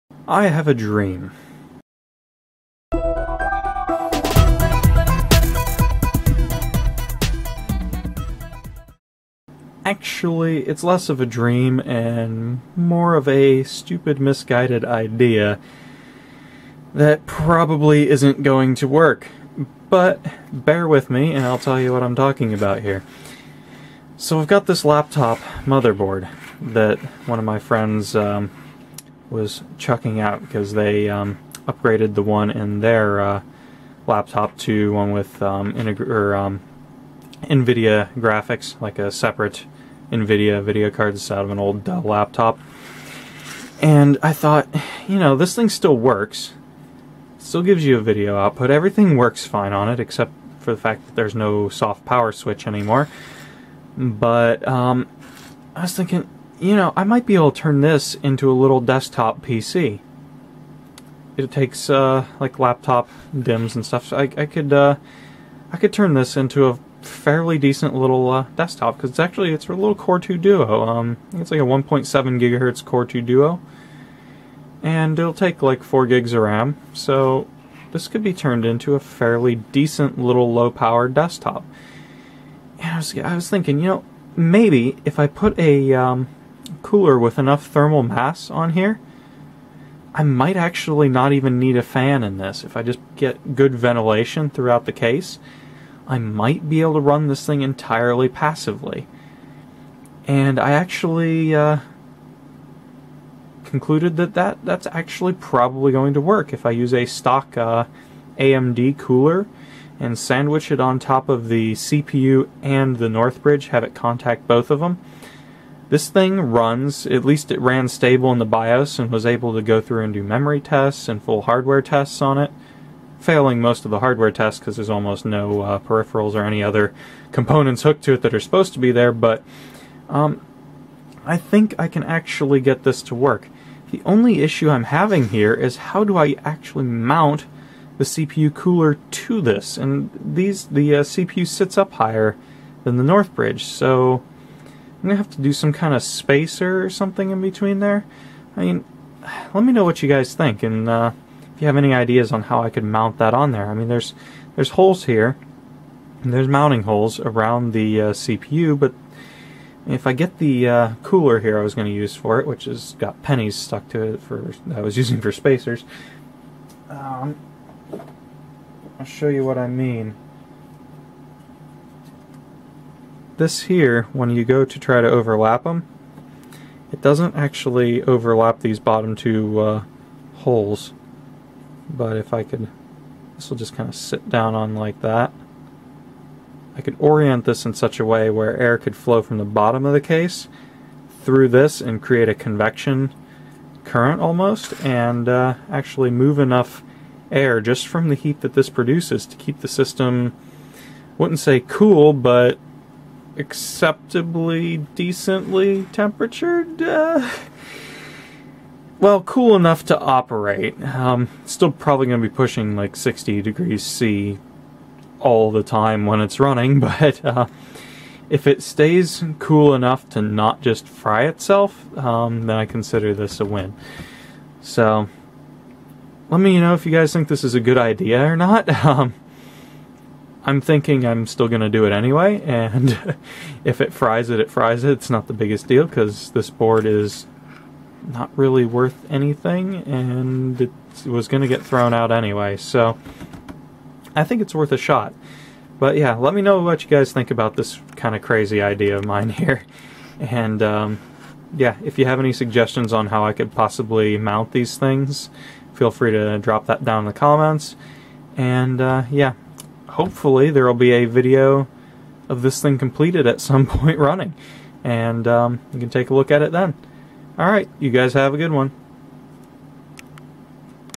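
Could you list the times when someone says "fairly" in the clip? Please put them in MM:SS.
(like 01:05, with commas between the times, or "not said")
01:07, 01:18.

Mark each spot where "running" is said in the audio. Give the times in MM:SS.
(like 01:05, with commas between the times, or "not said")
03:36, 04:23.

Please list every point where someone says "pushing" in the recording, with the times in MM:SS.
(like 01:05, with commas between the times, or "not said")
03:32.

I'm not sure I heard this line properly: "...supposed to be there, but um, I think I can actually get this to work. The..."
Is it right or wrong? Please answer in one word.
right.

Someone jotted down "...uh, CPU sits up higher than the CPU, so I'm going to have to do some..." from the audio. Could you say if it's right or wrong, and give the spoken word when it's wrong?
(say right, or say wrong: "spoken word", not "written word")
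wrong: "Northbridge", not "CPU".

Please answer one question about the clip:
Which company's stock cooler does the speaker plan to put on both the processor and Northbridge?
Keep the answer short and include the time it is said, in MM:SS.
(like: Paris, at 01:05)
AMD, at 01:48.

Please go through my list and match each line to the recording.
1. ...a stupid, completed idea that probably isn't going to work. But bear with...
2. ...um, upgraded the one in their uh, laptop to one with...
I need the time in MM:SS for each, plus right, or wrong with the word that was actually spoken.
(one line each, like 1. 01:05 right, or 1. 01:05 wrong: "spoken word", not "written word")
1. 00:13 wrong: "misguided", not "completed"
2. 00:31 right.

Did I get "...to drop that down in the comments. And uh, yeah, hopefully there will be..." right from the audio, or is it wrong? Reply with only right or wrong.
right.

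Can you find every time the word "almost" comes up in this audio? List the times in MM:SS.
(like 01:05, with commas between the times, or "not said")
02:04, 03:14.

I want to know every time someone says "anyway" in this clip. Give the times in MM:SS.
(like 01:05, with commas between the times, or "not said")
03:51, 04:02.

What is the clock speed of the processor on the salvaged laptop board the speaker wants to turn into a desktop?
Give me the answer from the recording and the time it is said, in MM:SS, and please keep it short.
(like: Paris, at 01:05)
1.7 GHz, at 01:11.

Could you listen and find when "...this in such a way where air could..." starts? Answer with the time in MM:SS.
03:07.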